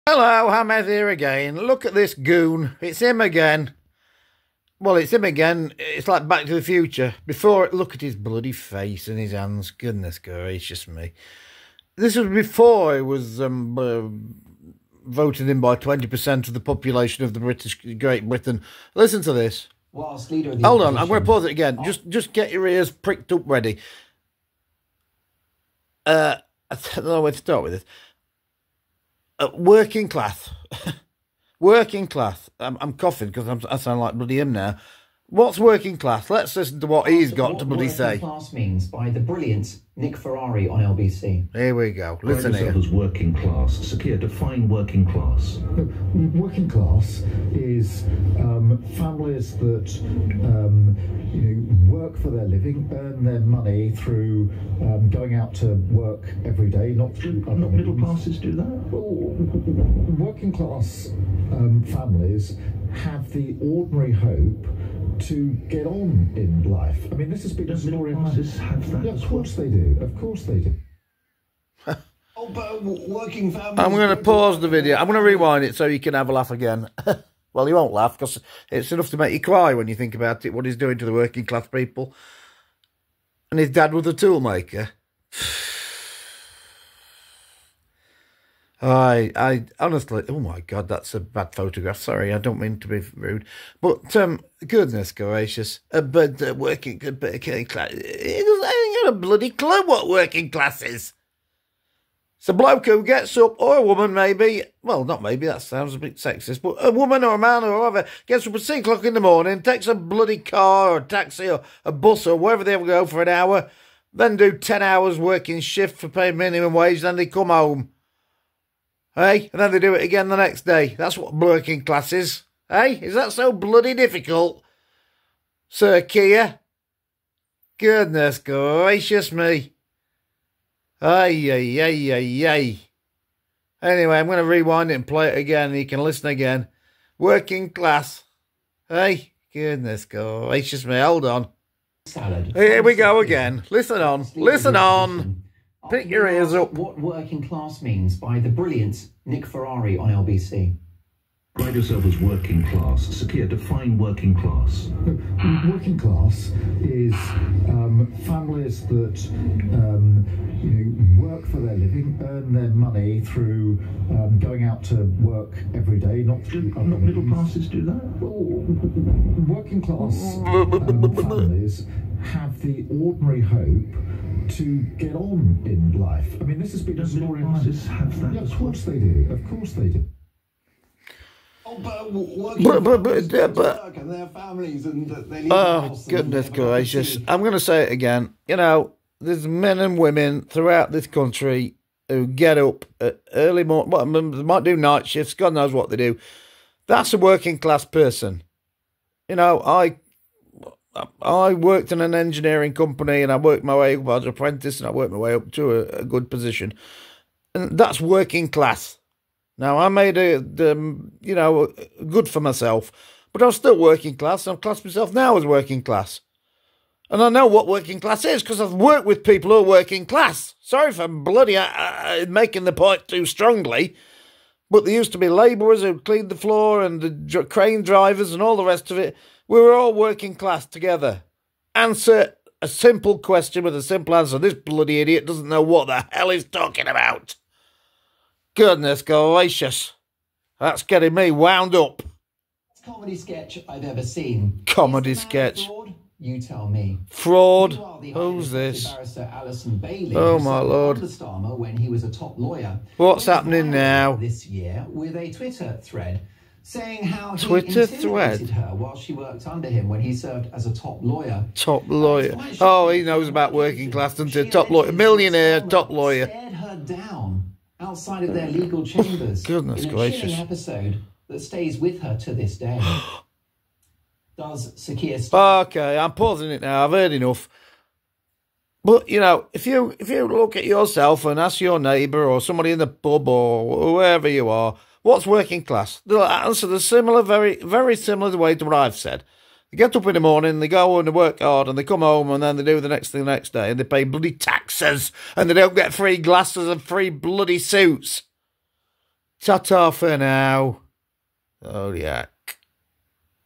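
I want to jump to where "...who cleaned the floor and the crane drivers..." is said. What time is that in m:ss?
3:45.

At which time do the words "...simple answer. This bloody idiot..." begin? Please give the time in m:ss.
3:53.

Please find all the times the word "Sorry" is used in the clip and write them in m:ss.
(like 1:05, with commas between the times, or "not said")
1:31, 3:40.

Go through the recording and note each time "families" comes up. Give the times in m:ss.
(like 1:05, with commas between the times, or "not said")
0:48, 1:01, 2:38, 2:51.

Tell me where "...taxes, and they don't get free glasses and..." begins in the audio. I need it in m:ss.
4:54.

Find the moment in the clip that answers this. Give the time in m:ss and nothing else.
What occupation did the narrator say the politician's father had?
1:24.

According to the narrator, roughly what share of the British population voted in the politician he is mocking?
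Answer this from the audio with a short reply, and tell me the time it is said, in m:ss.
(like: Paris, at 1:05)
20%, at 0:15.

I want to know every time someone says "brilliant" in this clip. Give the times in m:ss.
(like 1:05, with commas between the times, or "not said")
0:39, 2:28.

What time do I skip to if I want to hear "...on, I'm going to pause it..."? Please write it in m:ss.
0:20.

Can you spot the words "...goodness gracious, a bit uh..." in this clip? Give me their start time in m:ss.
1:34.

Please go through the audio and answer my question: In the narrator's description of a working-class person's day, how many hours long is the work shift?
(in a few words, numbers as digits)
10 hours.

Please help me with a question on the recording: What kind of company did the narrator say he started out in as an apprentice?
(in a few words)
Engineering company.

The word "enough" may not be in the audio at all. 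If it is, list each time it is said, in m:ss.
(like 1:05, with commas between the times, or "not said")
1:18, 4:37.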